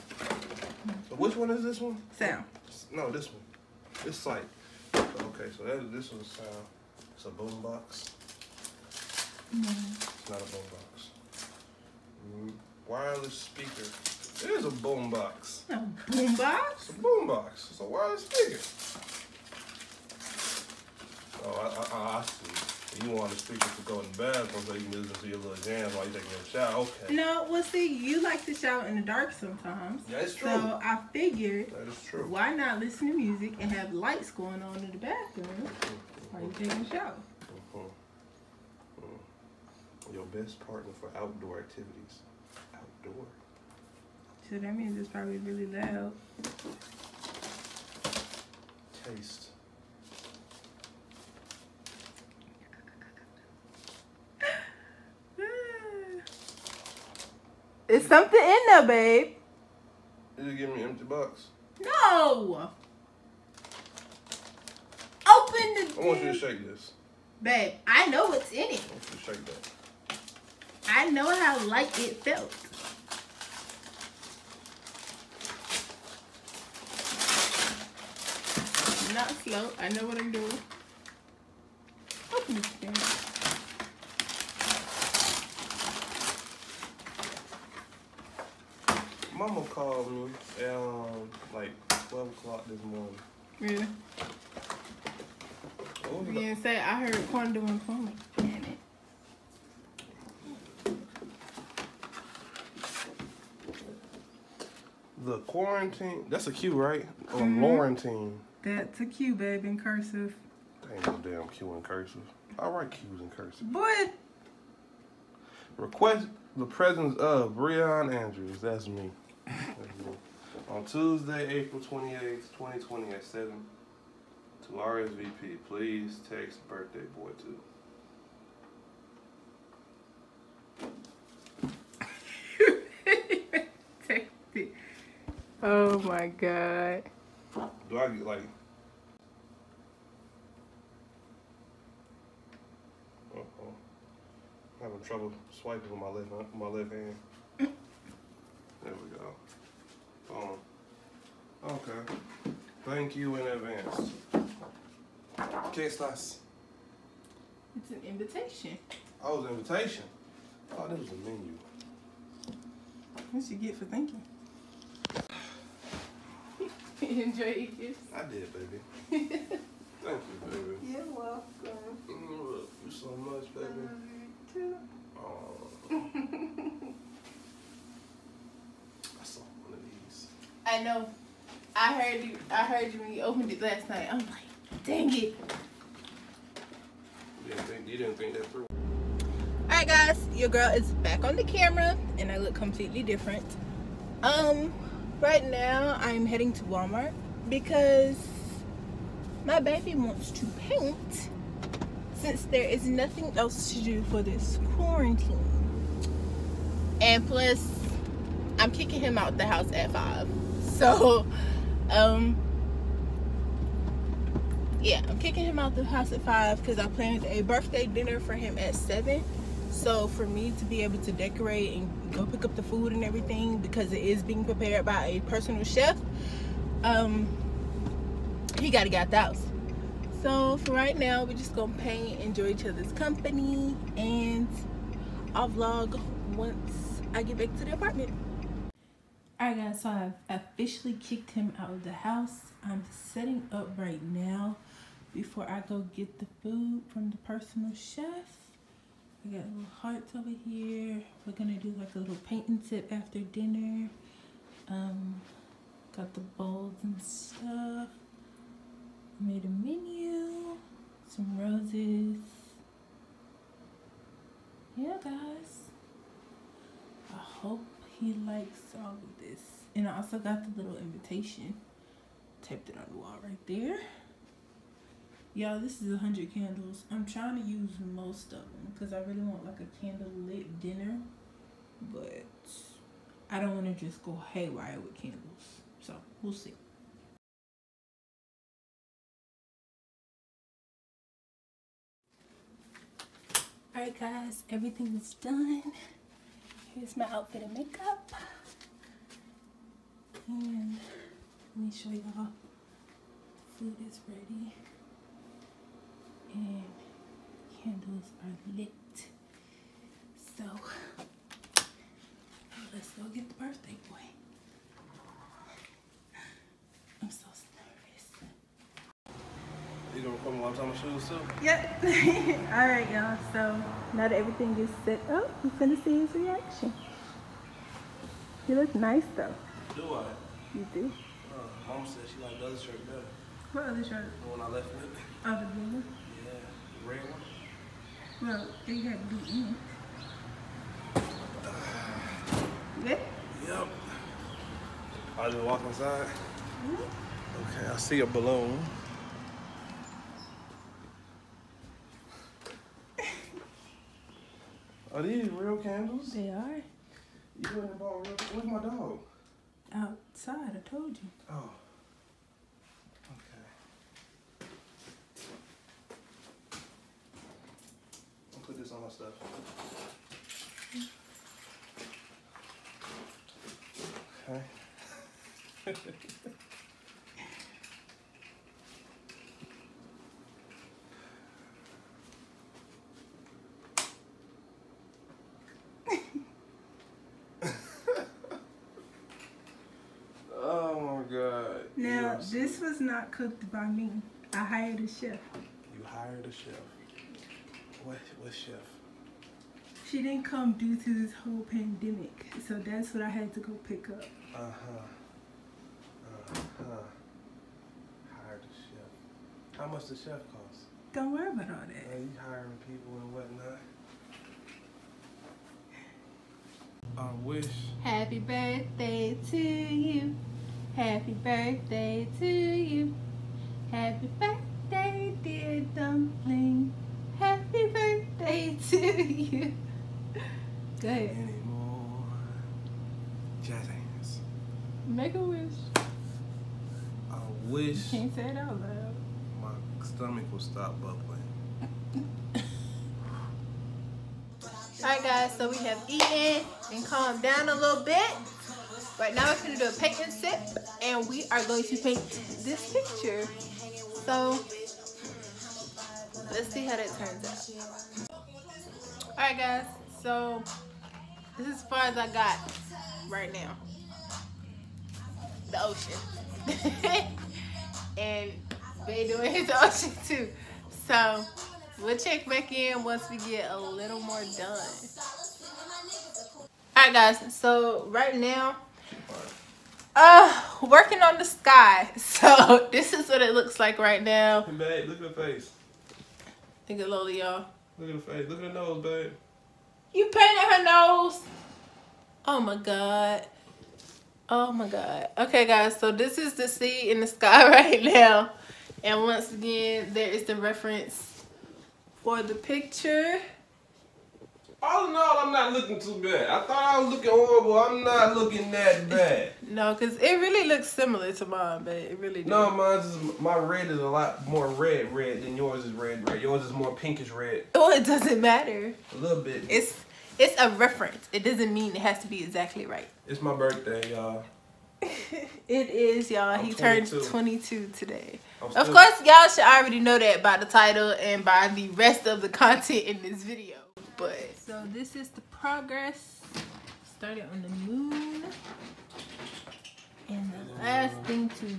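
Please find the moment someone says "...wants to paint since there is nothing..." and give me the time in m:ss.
3:19.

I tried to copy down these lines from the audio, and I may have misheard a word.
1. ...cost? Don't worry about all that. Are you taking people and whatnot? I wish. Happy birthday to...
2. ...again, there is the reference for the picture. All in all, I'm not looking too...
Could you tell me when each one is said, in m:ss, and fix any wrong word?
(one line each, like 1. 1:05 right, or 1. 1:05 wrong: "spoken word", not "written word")
1. 6:50 wrong: "hiring", not "taking"
2. 8:19 right.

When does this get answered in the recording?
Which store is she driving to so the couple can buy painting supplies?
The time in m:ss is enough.
3:16.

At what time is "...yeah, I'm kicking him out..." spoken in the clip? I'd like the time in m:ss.
3:34.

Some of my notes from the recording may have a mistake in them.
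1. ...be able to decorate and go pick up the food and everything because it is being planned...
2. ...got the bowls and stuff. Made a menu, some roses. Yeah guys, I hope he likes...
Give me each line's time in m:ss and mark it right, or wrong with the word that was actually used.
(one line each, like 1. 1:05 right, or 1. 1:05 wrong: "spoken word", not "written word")
1. 3:40 wrong: "prepared", not "planned"
2. 4:15 right.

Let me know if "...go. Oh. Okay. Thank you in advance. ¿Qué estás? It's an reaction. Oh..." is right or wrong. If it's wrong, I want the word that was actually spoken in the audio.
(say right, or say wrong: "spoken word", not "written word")
wrong: "invitation", not "reaction".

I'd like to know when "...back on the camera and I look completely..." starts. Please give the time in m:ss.
3:10.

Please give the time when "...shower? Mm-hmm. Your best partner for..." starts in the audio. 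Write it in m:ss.
0:36.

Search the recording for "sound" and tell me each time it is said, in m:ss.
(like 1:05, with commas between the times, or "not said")
0:02, 0:06.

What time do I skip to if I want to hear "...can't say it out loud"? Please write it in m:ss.
7:17.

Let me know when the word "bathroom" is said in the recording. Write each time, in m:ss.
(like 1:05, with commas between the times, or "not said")
0:24, 0:34.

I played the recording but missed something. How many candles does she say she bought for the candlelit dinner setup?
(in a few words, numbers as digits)
100.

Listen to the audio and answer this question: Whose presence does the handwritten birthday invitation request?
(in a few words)
Breon Andrews.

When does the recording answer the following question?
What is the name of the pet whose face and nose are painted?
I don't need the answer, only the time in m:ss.
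8:06.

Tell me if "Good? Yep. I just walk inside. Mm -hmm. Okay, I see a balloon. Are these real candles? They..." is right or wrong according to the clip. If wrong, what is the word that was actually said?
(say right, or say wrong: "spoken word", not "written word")
right.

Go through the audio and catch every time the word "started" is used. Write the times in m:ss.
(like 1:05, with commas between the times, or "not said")
8:56.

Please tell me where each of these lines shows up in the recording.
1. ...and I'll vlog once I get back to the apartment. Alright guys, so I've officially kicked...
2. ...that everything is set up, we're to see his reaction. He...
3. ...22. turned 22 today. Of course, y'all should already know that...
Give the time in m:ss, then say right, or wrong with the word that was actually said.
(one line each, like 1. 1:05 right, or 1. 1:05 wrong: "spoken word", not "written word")
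1. 3:53 right
2. 5:24 right
3. 8:46 right.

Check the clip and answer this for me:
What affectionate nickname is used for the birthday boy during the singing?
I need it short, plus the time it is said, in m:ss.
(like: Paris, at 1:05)
dumpling, at 7:05.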